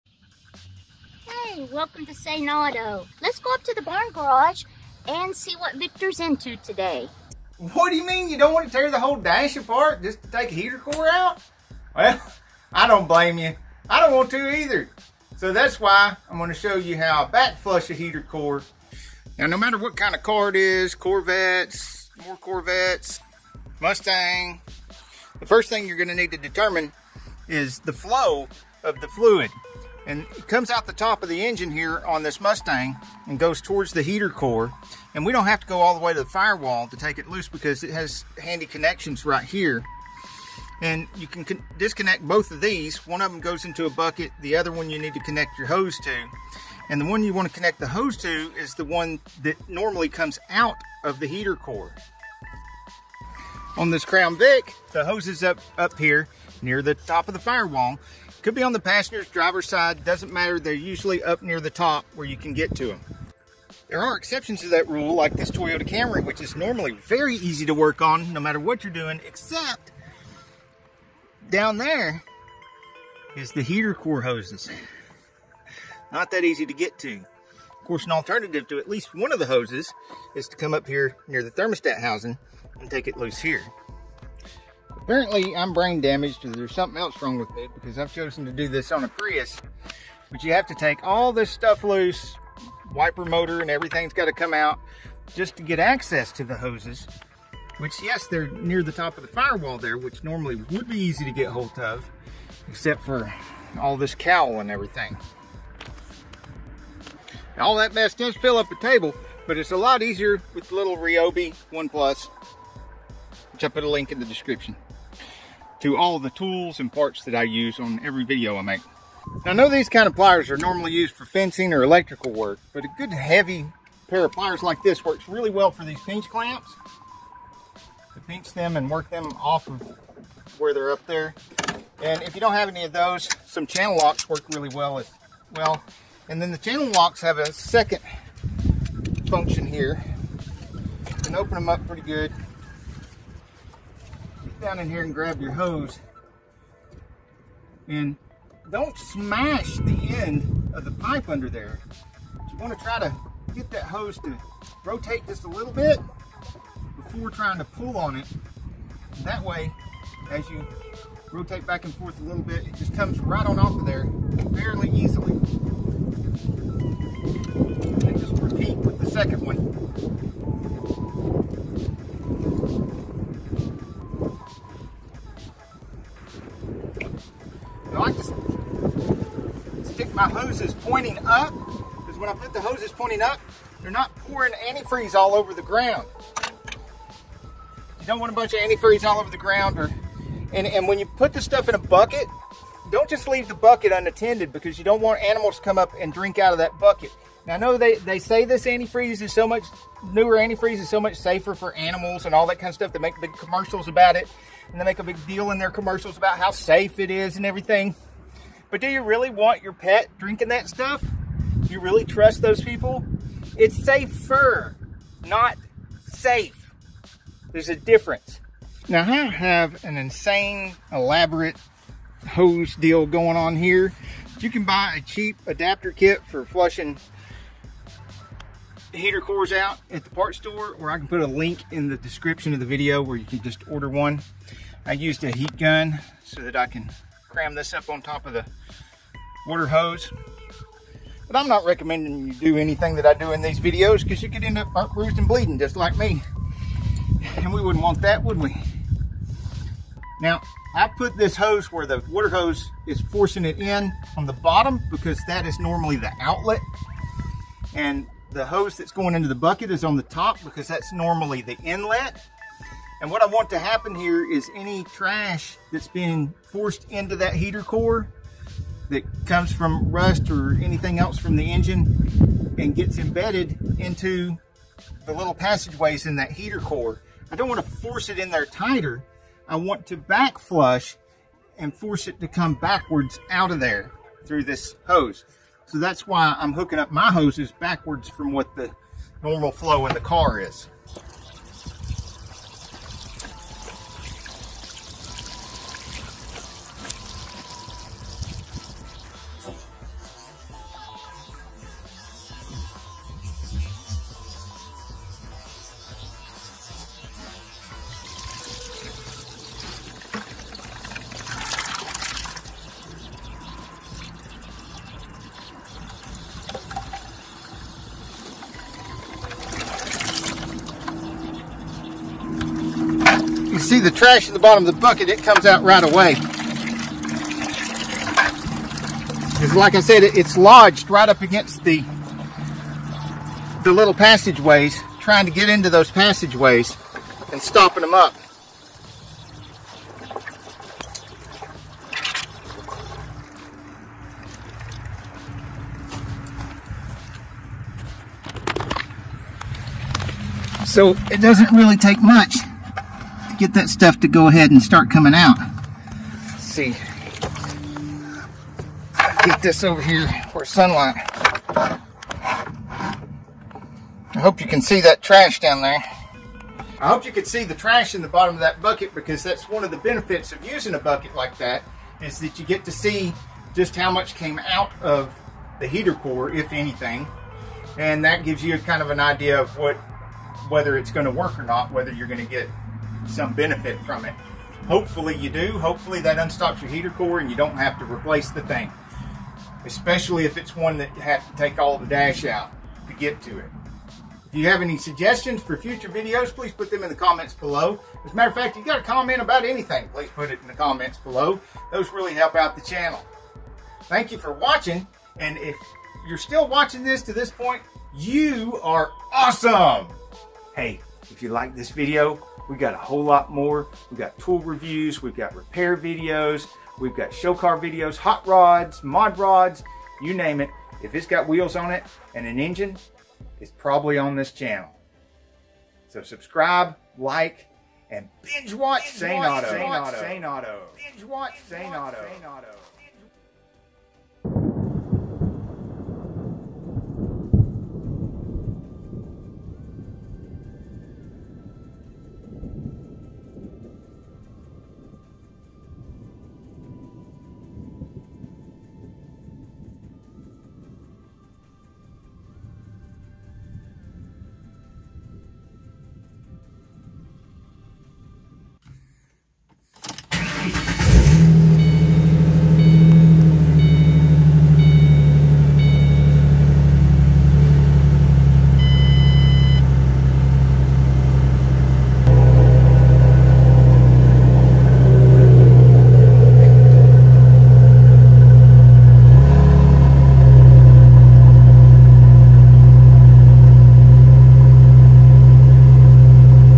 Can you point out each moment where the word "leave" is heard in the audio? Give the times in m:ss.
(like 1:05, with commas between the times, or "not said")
3:13.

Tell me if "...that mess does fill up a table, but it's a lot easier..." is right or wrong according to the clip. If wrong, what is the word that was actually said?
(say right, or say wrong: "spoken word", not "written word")
right.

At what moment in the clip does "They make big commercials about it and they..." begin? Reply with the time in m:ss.
3:22.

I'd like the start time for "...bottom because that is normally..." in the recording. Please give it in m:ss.
4:14.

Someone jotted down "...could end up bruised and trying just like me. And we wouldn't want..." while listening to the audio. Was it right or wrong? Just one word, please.
wrong.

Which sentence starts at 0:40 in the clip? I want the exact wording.
And you can disconnect both of these.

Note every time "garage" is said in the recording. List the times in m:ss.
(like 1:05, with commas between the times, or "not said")
0:04.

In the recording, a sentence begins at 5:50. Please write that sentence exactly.
So it doesn't really take much get that stuff to go ahead and start coming out.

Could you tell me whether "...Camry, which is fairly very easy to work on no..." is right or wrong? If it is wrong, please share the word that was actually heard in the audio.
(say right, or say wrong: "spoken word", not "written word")
wrong: "normally", not "fairly".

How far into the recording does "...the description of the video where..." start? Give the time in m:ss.
3:51.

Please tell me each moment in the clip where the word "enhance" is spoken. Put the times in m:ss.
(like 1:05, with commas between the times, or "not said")
not said.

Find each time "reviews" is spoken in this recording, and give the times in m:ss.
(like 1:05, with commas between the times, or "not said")
6:54.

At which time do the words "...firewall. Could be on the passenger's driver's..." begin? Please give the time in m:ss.
0:57.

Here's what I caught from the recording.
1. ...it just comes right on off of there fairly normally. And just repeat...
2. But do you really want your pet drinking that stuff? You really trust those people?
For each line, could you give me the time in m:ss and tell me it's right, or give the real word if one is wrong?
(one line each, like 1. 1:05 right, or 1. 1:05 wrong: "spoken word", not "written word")
1. 2:42 wrong: "easily", not "normally"
2. 3:28 right.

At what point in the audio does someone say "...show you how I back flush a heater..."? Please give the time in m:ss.
0:16.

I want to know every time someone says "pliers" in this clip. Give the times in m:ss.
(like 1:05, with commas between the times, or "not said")
2:00, 2:04.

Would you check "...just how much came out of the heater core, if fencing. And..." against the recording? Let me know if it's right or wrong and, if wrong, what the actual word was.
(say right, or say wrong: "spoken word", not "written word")
wrong: "anything", not "fencing".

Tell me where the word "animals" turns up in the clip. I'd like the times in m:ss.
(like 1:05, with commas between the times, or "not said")
3:15, 3:21.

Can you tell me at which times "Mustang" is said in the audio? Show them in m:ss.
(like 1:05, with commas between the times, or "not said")
0:23, 0:32.